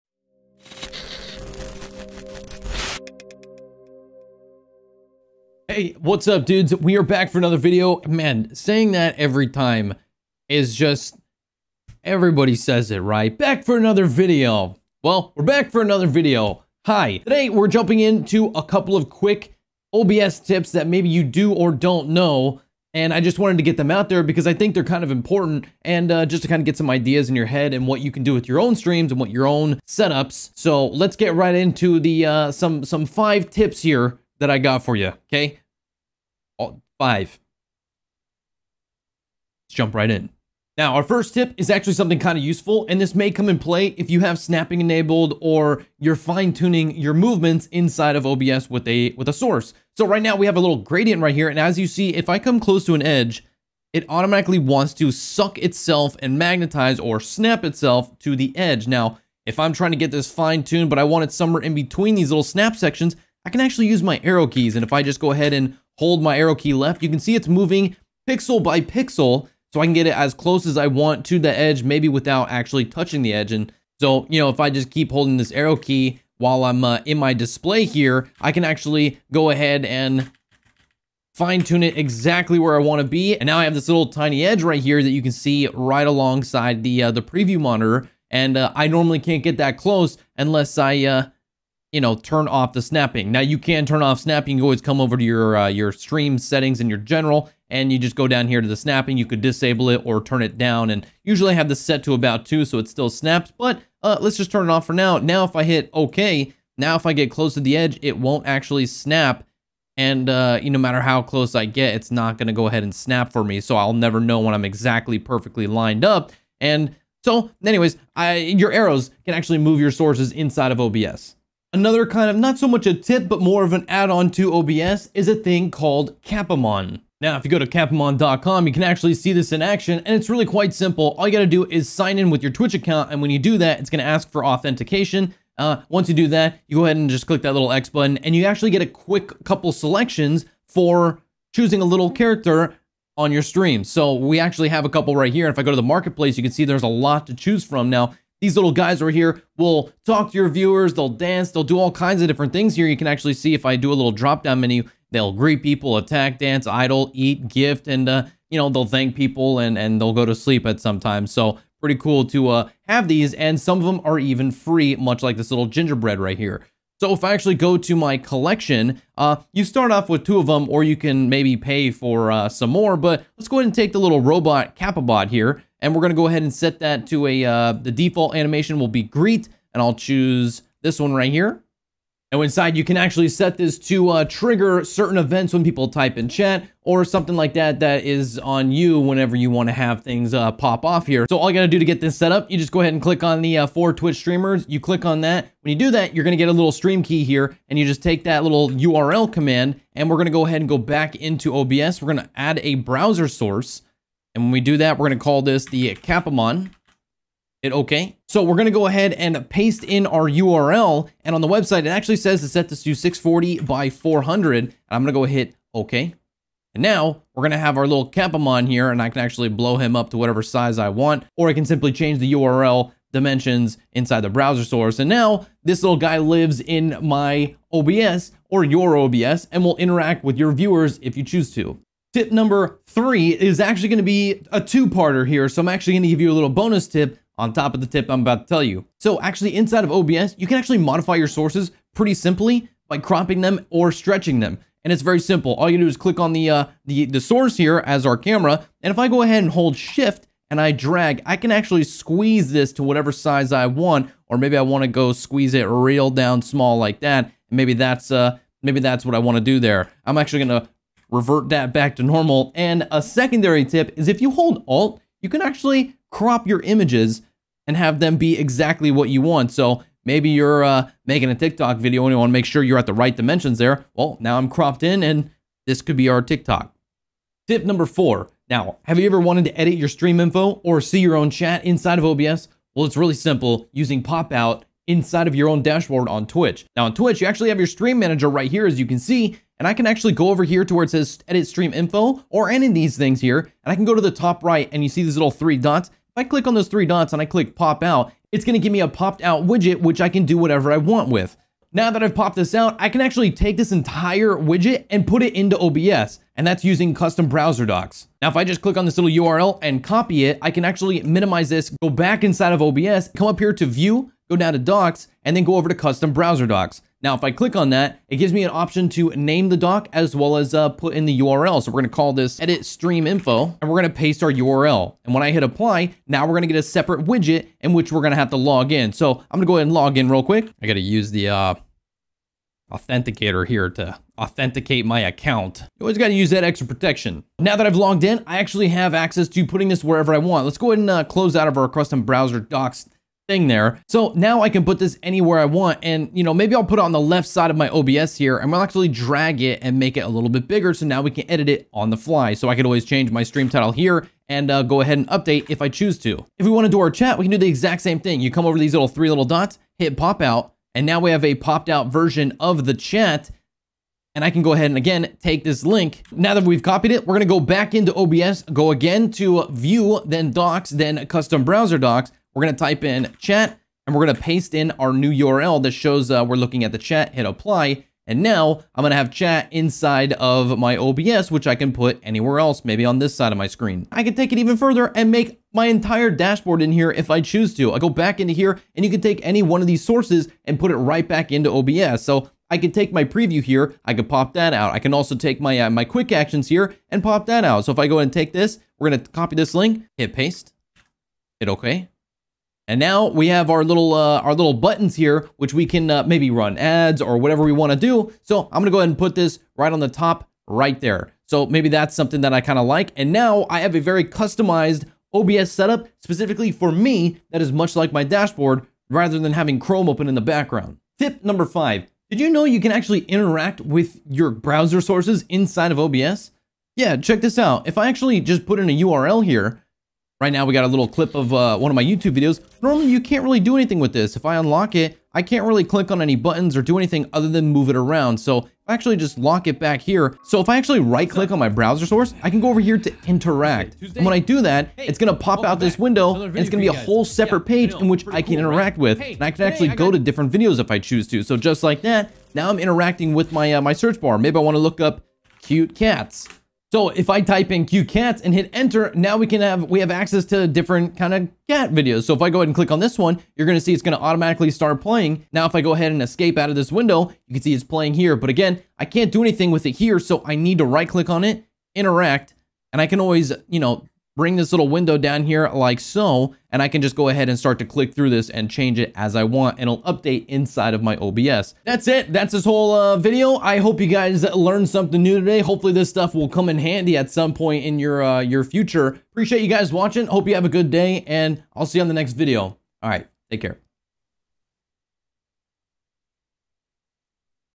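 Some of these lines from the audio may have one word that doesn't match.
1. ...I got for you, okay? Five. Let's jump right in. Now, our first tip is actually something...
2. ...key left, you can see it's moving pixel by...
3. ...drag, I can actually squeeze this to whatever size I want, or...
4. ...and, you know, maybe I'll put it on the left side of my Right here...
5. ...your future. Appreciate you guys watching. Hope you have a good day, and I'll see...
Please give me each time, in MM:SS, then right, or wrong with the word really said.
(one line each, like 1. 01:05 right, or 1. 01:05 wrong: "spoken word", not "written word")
1. 00:34 right
2. 01:06 right
3. 04:10 right
4. 05:45 wrong: "OBS", not "Right"
5. 08:08 right.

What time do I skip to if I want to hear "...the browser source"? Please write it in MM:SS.
03:44.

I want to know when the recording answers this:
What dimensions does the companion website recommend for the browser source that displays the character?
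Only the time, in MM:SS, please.
03:32.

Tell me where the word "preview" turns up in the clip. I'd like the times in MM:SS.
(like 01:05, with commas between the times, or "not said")
01:27, 06:33.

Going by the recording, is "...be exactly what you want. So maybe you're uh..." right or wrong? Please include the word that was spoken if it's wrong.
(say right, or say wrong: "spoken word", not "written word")
right.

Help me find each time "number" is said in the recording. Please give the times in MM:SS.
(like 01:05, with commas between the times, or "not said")
03:52, 04:37, 07:01.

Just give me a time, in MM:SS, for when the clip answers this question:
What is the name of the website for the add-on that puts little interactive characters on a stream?
02:07.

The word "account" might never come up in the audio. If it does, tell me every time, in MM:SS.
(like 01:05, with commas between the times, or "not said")
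02:12, 05:35.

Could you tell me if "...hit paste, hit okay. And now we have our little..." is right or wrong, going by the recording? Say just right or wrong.
right.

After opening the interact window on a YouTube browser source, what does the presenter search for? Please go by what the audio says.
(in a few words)
cute cats.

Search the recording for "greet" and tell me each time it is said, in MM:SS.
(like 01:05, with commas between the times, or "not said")
02:35, 02:59.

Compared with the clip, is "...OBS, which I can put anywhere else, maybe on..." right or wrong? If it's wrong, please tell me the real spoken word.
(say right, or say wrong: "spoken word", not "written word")
right.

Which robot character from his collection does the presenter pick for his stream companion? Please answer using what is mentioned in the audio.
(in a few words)
Capabot.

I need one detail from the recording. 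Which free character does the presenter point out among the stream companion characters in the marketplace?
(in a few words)
gingerbread.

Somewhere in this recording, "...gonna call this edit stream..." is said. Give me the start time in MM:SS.
05:21.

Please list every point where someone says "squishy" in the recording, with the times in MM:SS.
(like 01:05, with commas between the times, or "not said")
not said.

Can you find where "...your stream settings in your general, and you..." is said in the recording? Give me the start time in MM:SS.
01:35.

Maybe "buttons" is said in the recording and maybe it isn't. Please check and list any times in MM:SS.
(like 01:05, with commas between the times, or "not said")
02:17, 06:44, 07:16.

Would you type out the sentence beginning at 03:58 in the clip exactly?
So actually inside of OBS, you can actually modify your sources pretty simply by cropping them or stretching them.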